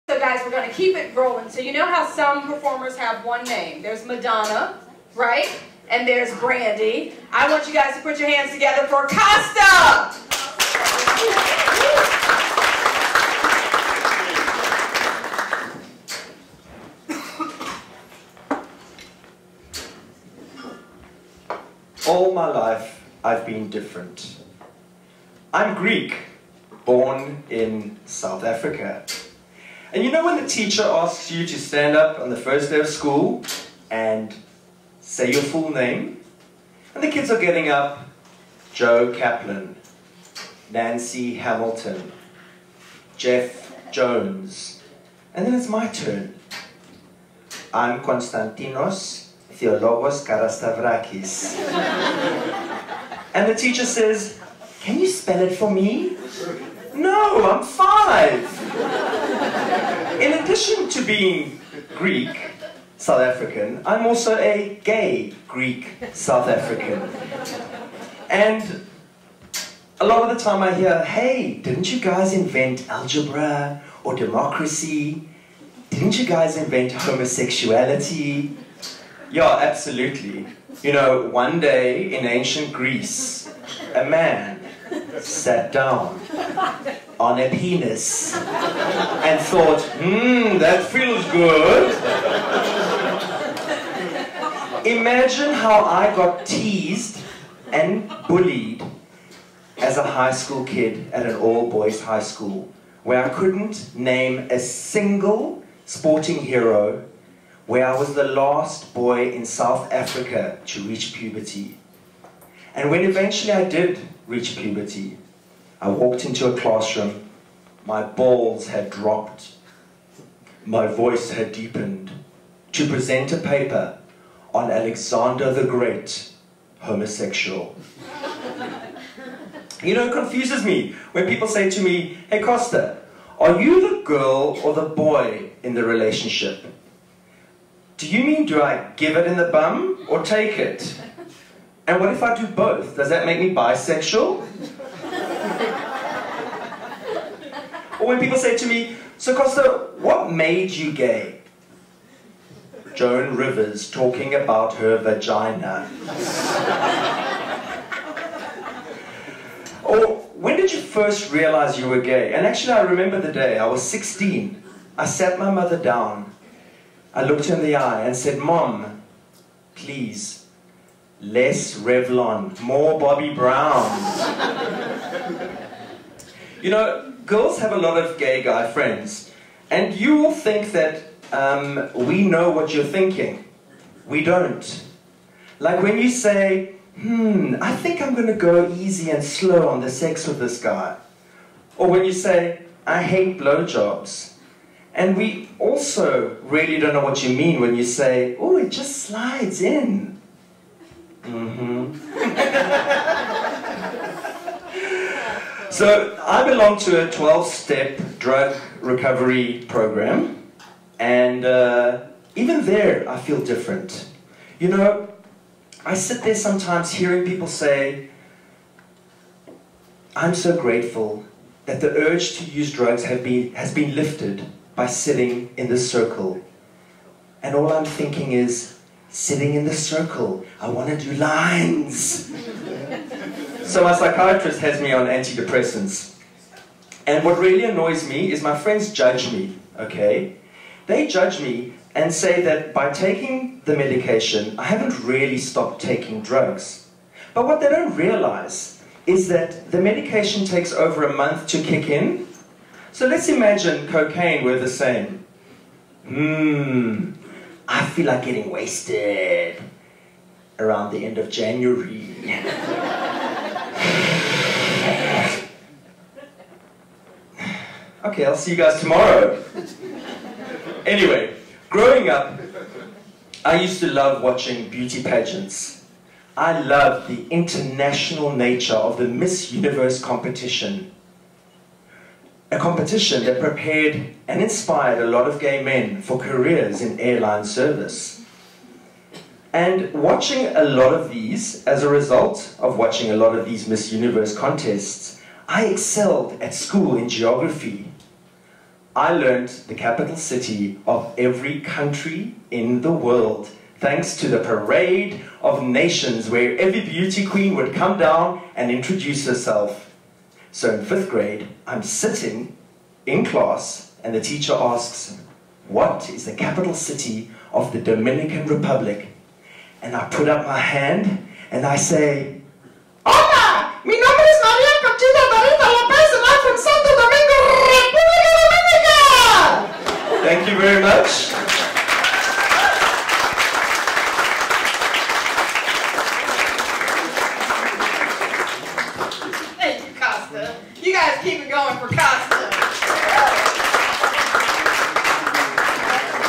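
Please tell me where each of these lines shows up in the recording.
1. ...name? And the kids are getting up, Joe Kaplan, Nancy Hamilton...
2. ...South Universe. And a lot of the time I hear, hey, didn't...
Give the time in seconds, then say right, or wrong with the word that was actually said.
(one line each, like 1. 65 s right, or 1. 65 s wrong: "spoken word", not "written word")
1. 35 s right
2. 66 s wrong: "African", not "Universe".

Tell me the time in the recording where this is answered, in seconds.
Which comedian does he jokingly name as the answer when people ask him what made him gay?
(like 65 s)
152 s.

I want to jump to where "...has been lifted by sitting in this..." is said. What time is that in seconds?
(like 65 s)
223 s.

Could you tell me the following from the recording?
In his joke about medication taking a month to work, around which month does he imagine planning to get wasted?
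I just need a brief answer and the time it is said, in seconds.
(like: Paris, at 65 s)
January, at 261 s.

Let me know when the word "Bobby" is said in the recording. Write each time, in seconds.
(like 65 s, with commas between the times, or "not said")
172 s.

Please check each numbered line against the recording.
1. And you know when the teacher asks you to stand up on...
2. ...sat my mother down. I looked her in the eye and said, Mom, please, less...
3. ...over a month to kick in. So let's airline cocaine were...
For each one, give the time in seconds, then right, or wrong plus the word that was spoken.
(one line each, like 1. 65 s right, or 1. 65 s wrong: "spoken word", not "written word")
1. 29 s right
2. 165 s right
3. 250 s wrong: "imagine", not "airline".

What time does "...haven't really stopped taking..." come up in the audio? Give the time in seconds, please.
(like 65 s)
244 s.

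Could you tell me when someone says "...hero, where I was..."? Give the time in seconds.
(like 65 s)
106 s.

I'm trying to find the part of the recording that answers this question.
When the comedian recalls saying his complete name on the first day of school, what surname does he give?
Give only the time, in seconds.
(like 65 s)
50 s.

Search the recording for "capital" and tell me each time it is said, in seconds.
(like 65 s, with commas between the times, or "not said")
299 s, 316 s.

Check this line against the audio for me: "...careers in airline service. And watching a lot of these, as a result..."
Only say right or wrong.
right.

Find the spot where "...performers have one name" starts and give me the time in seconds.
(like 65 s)
2 s.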